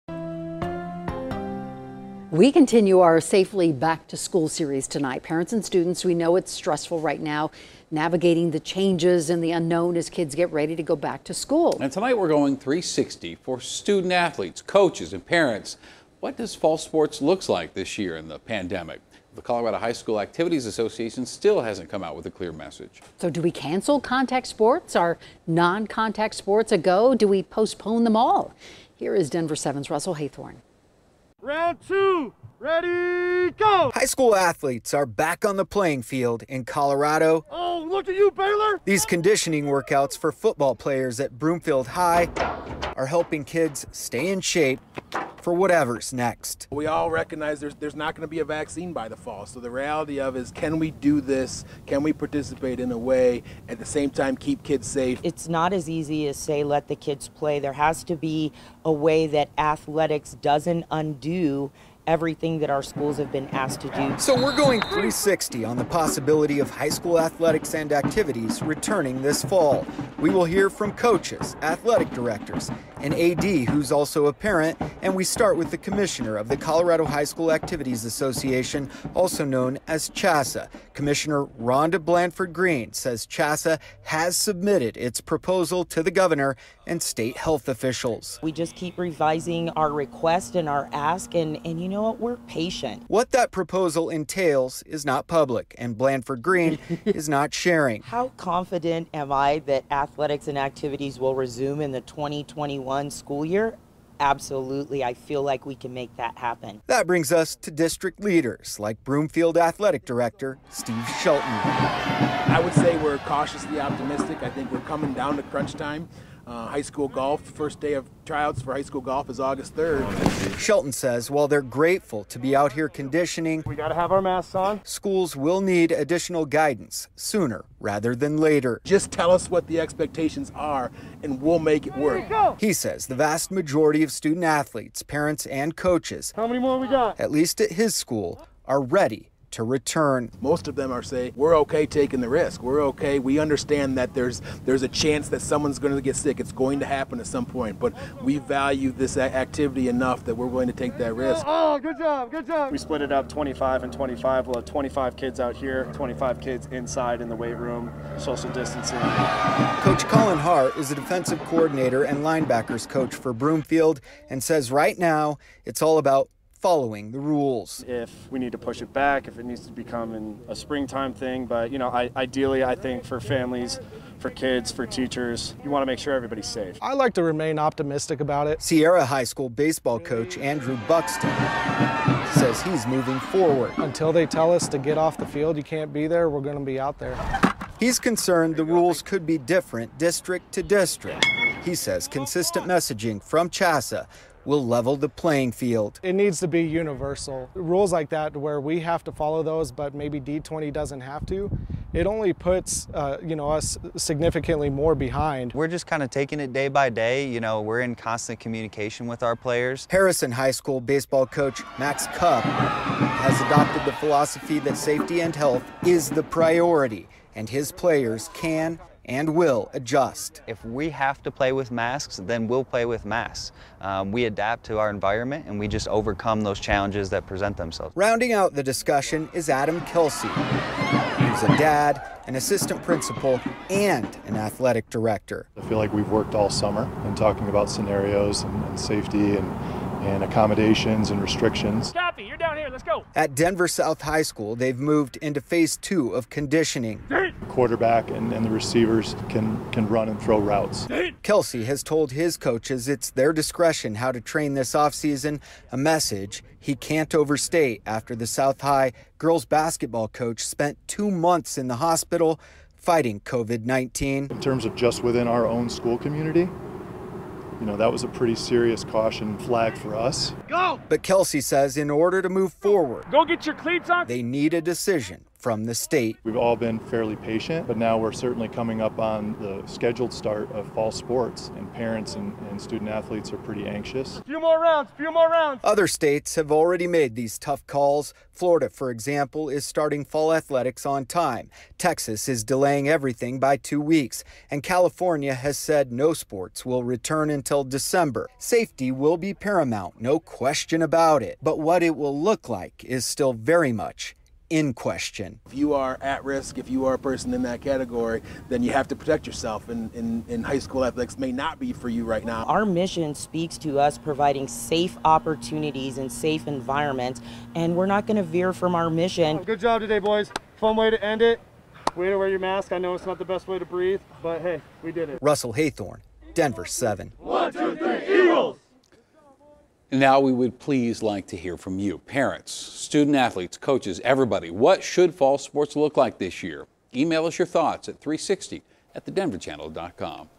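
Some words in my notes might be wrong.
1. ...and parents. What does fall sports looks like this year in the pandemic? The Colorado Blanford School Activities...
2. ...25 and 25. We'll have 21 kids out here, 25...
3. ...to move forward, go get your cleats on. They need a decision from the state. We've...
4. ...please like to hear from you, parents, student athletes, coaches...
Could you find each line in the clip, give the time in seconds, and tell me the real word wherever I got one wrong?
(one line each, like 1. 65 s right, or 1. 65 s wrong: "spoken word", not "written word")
1. 15 s wrong: "High", not "Blanford"
2. 153 s wrong: "25", not "21"
3. 272 s right
4. 330 s right.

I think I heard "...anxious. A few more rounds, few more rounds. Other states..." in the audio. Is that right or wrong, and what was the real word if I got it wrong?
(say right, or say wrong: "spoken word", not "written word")
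right.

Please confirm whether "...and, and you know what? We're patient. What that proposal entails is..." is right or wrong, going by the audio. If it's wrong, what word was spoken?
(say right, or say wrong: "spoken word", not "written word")
right.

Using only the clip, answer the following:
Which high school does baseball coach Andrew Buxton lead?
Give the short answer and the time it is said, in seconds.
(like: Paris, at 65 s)
Sierra High School, at 178 s.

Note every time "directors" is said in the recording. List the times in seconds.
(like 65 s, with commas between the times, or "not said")
72 s, 110 s, 234 s.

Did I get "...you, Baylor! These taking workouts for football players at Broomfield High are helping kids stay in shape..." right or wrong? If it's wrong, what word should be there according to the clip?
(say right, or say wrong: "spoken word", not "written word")
wrong: "conditioning", not "taking".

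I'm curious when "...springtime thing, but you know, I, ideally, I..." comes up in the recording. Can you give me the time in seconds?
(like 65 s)
170 s.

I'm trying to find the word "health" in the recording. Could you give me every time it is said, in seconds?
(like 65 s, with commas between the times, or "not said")
87 s, 215 s.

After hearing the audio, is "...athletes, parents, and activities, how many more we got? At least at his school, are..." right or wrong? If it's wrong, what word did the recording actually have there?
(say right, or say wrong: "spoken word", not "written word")
wrong: "coaches", not "activities".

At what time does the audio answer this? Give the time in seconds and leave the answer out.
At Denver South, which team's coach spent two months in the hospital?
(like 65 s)
259 s.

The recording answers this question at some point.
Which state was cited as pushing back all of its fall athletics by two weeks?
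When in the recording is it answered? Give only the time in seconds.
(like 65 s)
291 s.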